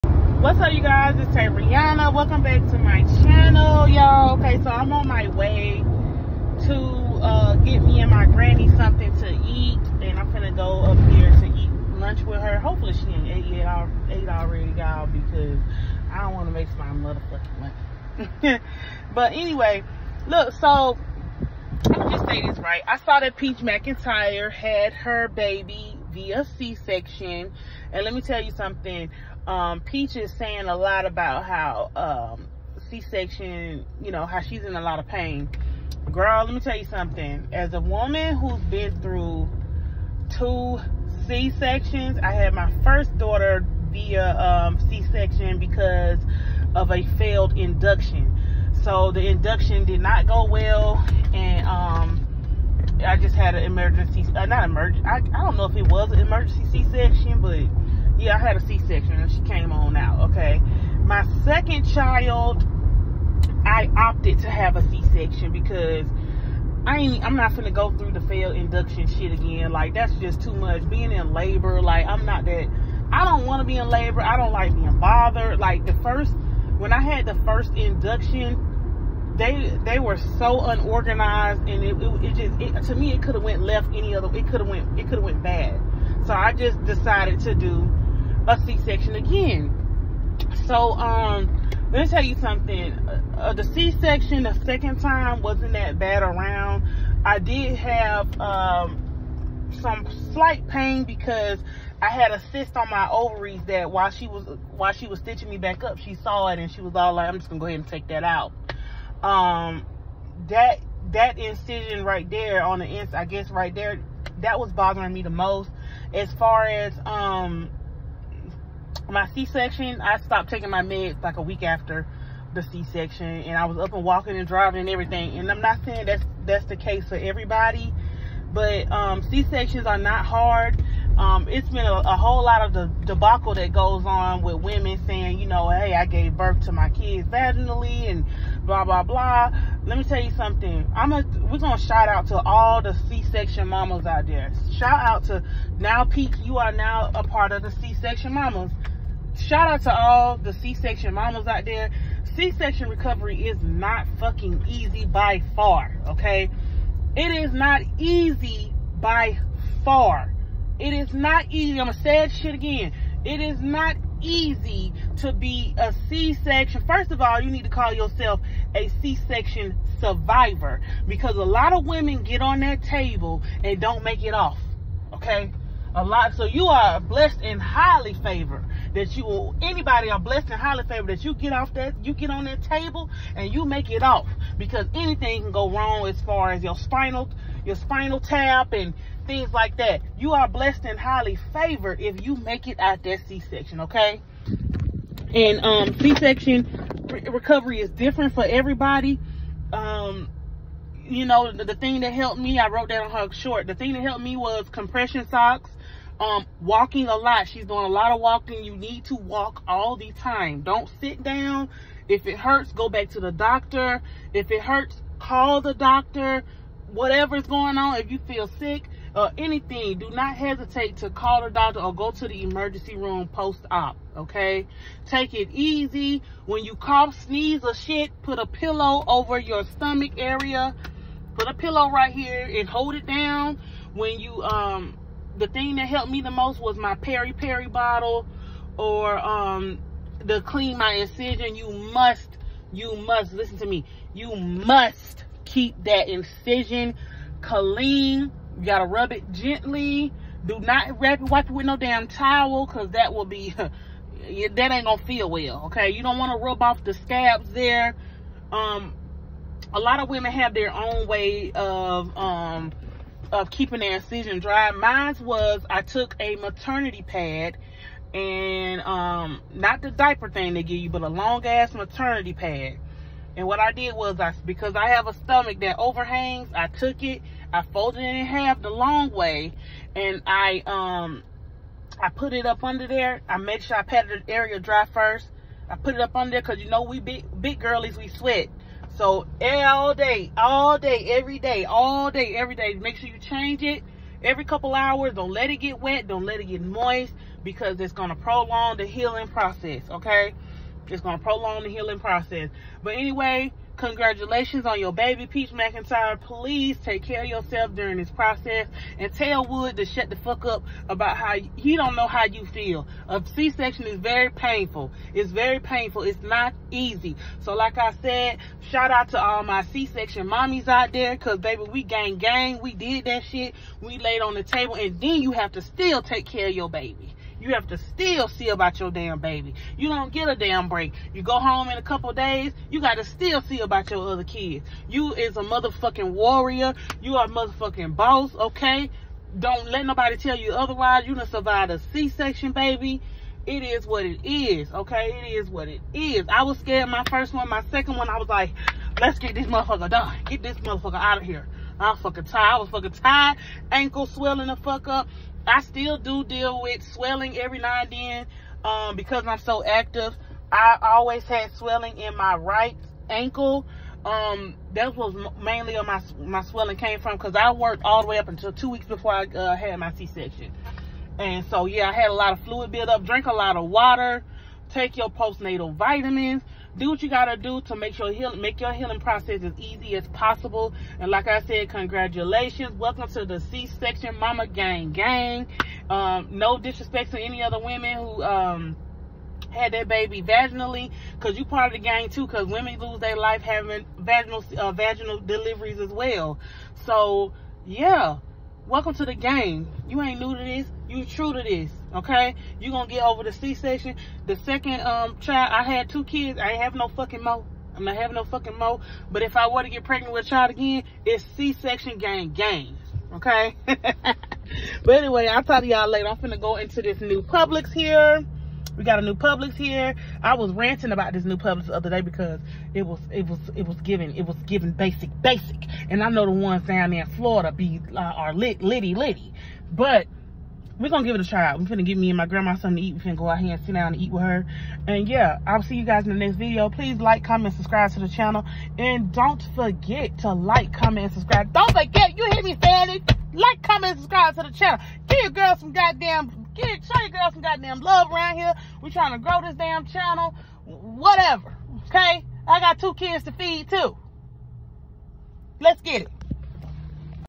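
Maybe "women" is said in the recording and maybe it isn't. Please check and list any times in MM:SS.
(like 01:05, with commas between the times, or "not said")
02:14, 02:51, 04:20, 06:27, 06:32.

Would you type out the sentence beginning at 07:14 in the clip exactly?
And yeah, I'll see you guys in the next video.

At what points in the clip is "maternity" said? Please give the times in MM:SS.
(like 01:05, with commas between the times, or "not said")
04:26, 04:31.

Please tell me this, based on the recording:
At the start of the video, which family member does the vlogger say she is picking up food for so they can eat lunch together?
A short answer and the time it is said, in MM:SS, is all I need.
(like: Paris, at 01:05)
Granny, at 00:08.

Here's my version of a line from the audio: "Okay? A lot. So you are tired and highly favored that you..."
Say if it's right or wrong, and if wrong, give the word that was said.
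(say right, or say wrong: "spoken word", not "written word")
wrong: "blessed", not "tired".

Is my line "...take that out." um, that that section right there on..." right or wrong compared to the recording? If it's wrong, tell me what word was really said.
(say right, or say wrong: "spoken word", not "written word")
wrong: "incision", not "section".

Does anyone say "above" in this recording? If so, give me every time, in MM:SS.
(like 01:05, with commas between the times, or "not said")
not said.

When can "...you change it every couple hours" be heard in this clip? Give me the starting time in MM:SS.
04:53.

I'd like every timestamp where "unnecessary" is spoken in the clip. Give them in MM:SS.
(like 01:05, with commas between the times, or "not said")
not said.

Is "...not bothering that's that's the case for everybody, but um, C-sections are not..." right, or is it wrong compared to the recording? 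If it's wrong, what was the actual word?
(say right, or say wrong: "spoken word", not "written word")
wrong: "saying", not "bothering".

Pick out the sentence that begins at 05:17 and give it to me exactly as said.
So like I said, shout out to all my C-section mommies out there because baby, we gang gang.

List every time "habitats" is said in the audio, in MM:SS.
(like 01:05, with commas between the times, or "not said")
not said.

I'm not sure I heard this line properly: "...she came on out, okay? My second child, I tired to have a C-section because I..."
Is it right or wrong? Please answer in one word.
wrong.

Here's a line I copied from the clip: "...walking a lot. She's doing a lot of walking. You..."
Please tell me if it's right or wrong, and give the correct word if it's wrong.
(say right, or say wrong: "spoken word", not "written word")
right.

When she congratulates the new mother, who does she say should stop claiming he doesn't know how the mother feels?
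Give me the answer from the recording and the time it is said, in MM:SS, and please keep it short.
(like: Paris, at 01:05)
Wood, at 05:09.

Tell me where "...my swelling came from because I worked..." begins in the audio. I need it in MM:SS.
06:06.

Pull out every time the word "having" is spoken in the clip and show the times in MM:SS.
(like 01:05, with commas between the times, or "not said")
06:33, 06:47.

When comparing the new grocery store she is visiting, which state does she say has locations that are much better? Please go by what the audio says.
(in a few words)
Florida.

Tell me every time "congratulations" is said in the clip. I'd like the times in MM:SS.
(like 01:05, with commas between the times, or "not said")
05:03, 06:21.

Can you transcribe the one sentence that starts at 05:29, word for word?
You don't get a damn break.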